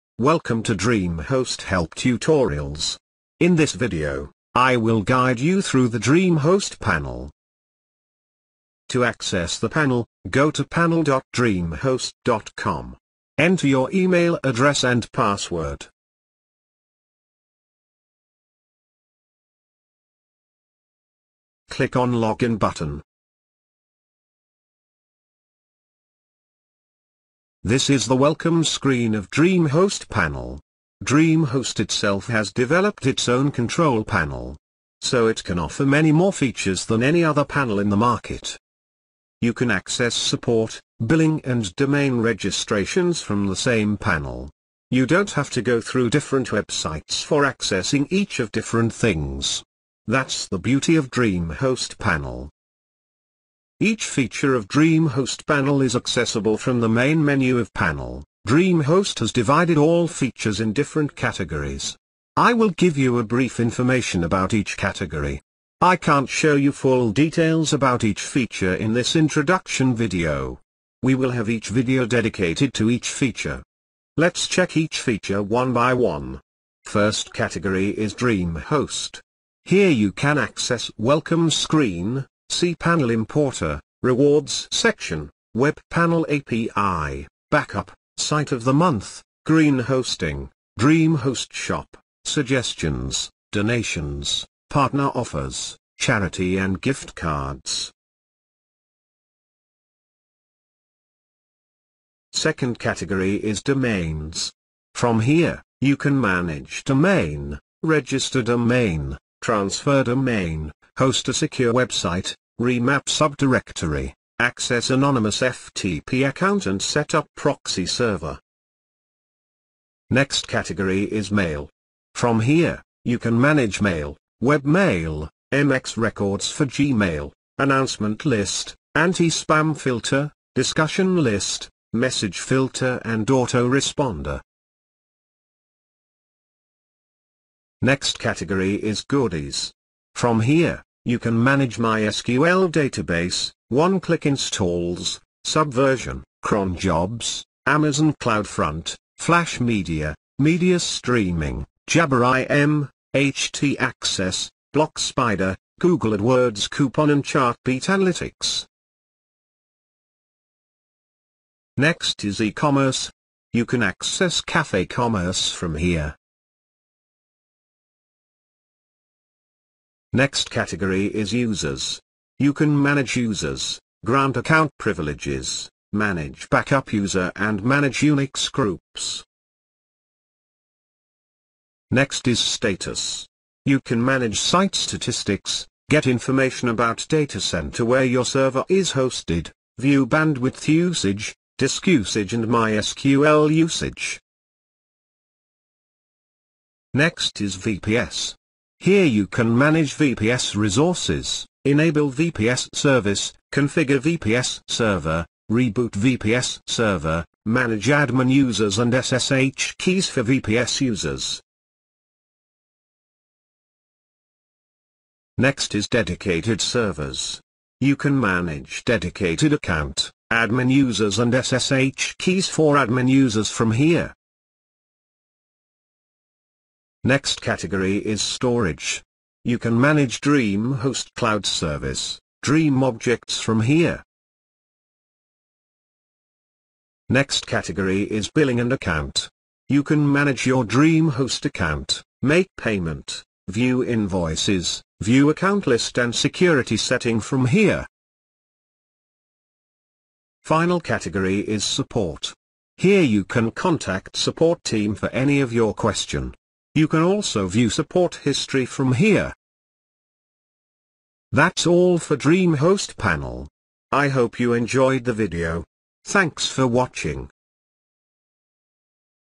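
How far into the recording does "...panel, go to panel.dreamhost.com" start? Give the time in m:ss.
0:09.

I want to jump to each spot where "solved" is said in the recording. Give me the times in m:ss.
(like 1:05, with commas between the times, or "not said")
not said.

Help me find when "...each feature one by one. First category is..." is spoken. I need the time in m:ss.
1:14.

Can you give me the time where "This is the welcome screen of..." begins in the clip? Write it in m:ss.
0:27.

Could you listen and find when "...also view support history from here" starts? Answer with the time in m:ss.
4:17.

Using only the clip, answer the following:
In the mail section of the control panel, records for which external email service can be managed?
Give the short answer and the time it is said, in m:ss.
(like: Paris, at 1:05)
Gmail, at 2:06.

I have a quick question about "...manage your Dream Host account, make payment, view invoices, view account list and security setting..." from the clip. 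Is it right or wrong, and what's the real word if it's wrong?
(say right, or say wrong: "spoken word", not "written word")
right.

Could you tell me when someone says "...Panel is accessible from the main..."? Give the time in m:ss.
0:55.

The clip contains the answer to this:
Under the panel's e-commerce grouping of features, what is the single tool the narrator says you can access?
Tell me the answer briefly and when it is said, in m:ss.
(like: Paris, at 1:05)
Cafe Commerce, at 2:44.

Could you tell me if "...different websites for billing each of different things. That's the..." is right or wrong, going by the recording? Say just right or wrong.
wrong.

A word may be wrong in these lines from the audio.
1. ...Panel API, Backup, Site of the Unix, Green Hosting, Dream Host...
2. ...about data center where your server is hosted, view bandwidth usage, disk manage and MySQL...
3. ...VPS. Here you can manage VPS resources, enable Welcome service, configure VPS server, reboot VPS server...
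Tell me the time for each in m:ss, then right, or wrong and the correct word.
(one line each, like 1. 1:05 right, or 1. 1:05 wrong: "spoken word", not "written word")
1. 1:25 wrong: "Month", not "Unix"
2. 3:06 wrong: "usage", not "manage"
3. 3:17 wrong: "VPS", not "Welcome".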